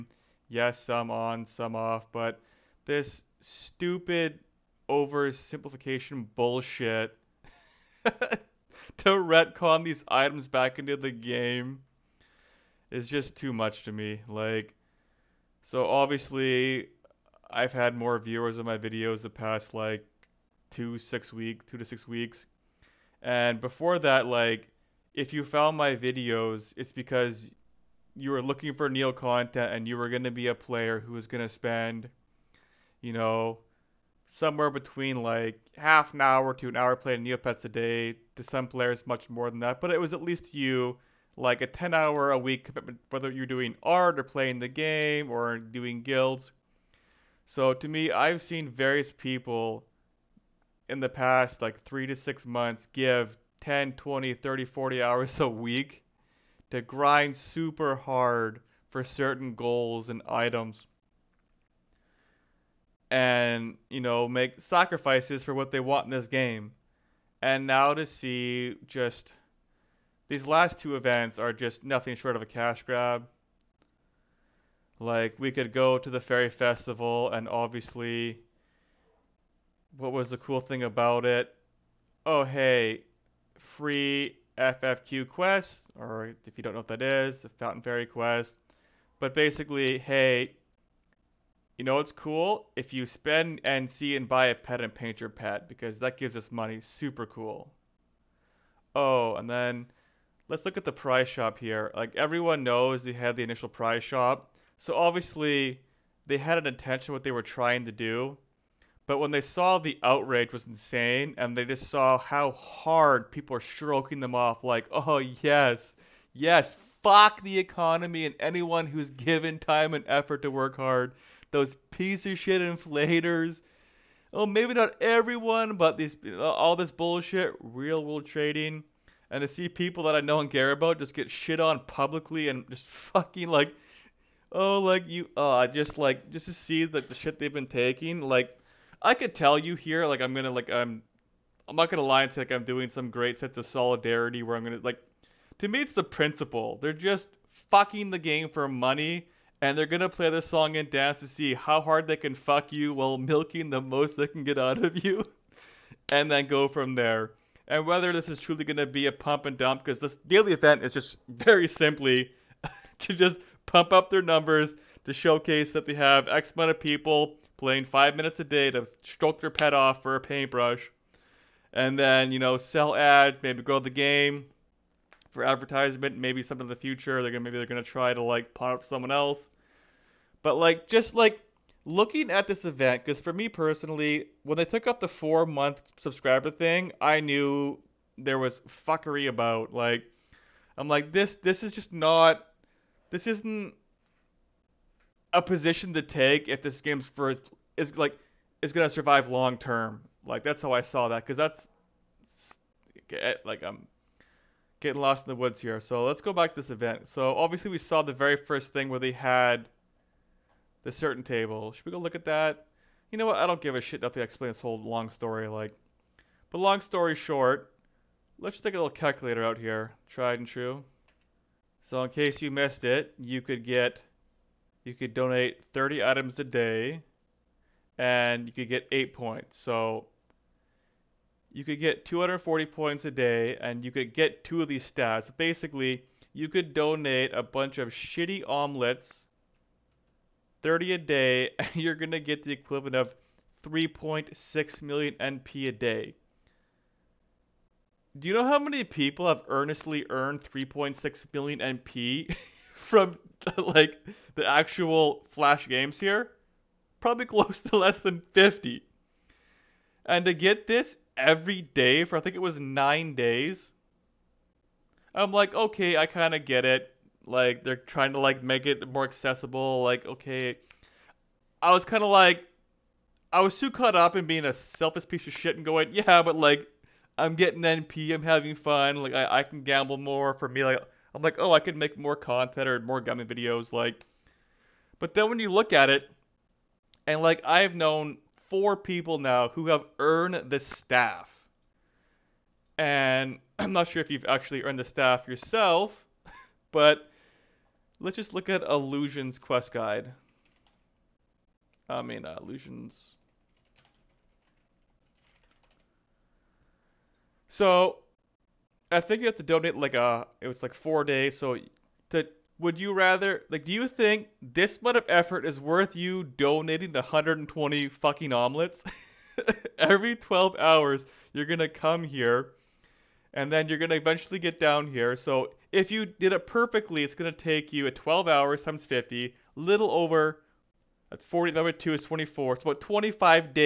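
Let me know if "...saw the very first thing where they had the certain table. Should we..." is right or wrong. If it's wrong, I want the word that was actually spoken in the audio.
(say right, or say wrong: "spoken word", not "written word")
right.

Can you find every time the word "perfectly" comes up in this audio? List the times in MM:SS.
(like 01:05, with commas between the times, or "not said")
05:26.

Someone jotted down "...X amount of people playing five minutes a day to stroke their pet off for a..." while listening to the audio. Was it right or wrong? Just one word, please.
right.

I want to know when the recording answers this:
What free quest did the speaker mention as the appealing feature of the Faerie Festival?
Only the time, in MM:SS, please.
01:27.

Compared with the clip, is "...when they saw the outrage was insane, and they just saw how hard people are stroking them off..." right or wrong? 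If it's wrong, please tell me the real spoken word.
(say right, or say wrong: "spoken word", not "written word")
right.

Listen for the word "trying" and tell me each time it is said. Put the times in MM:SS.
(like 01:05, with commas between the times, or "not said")
01:47, 04:27.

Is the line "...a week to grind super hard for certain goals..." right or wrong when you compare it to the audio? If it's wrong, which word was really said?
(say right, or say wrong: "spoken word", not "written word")
right.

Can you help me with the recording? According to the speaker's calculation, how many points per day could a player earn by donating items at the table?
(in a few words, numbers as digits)
240.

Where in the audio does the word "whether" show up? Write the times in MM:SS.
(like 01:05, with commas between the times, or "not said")
00:43, 02:37.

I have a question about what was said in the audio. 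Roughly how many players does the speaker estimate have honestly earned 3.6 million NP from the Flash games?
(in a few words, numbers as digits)
less than 50.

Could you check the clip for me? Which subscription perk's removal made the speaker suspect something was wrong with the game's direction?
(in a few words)
four month subscriber thing.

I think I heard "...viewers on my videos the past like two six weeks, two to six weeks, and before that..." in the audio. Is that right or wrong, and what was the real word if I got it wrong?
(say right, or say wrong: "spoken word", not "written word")
right.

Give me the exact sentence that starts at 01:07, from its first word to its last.
And now to see just these last two events are just nothing short of a cash grab.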